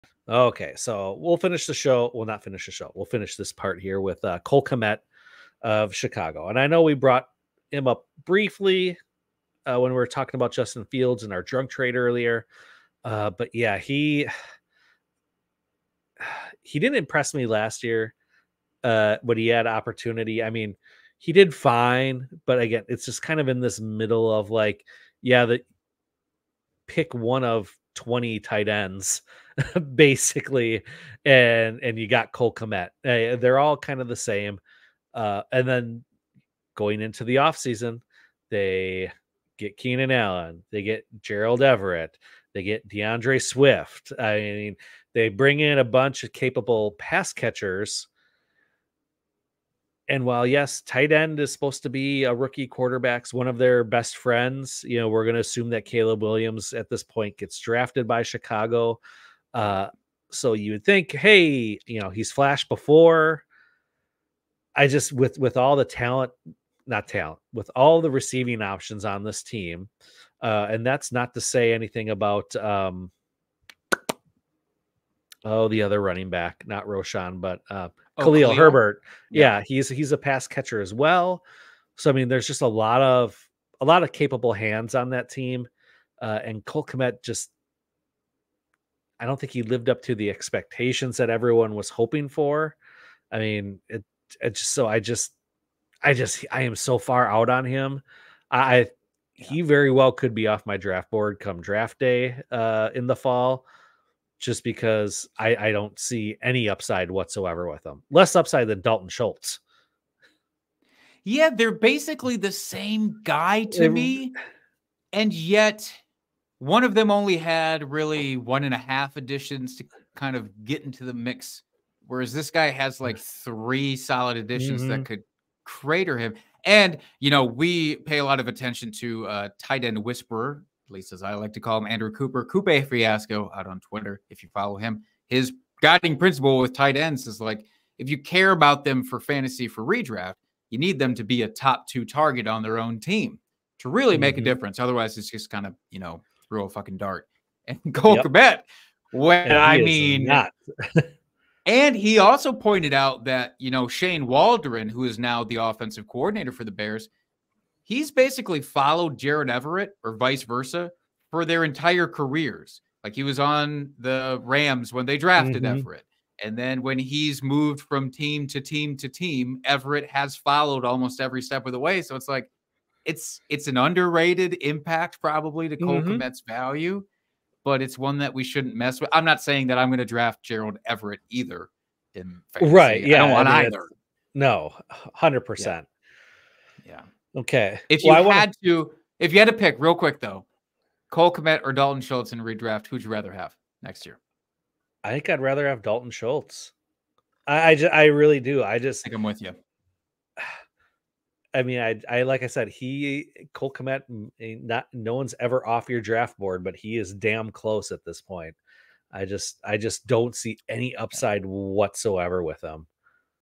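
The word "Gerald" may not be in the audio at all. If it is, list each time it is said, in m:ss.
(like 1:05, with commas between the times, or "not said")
0:41, 3:00.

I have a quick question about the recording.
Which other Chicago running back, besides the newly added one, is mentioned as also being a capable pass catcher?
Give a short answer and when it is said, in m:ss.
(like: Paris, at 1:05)
Khalil Herbert, at 1:18.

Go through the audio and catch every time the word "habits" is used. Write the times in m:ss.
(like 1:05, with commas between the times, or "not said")
not said.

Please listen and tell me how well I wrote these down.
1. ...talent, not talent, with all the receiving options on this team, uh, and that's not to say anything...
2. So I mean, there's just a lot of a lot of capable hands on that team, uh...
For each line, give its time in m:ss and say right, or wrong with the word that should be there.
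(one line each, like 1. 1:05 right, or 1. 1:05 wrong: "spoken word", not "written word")
1. 1:05 right
2. 1:21 right.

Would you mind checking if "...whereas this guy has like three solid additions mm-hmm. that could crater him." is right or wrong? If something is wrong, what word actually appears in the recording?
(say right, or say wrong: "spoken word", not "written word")
right.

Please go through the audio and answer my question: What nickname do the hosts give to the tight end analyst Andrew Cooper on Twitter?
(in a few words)
Coupe Fiasco.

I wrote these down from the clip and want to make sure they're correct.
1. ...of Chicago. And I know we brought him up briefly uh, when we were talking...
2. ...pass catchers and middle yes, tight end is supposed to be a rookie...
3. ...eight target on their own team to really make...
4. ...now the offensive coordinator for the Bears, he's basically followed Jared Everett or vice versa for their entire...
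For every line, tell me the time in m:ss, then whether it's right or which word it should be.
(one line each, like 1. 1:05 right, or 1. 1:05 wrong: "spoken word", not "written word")
1. 0:05 right
2. 0:46 wrong: "while", not "middle"
3. 2:21 wrong: "two", not "eight"
4. 2:35 right.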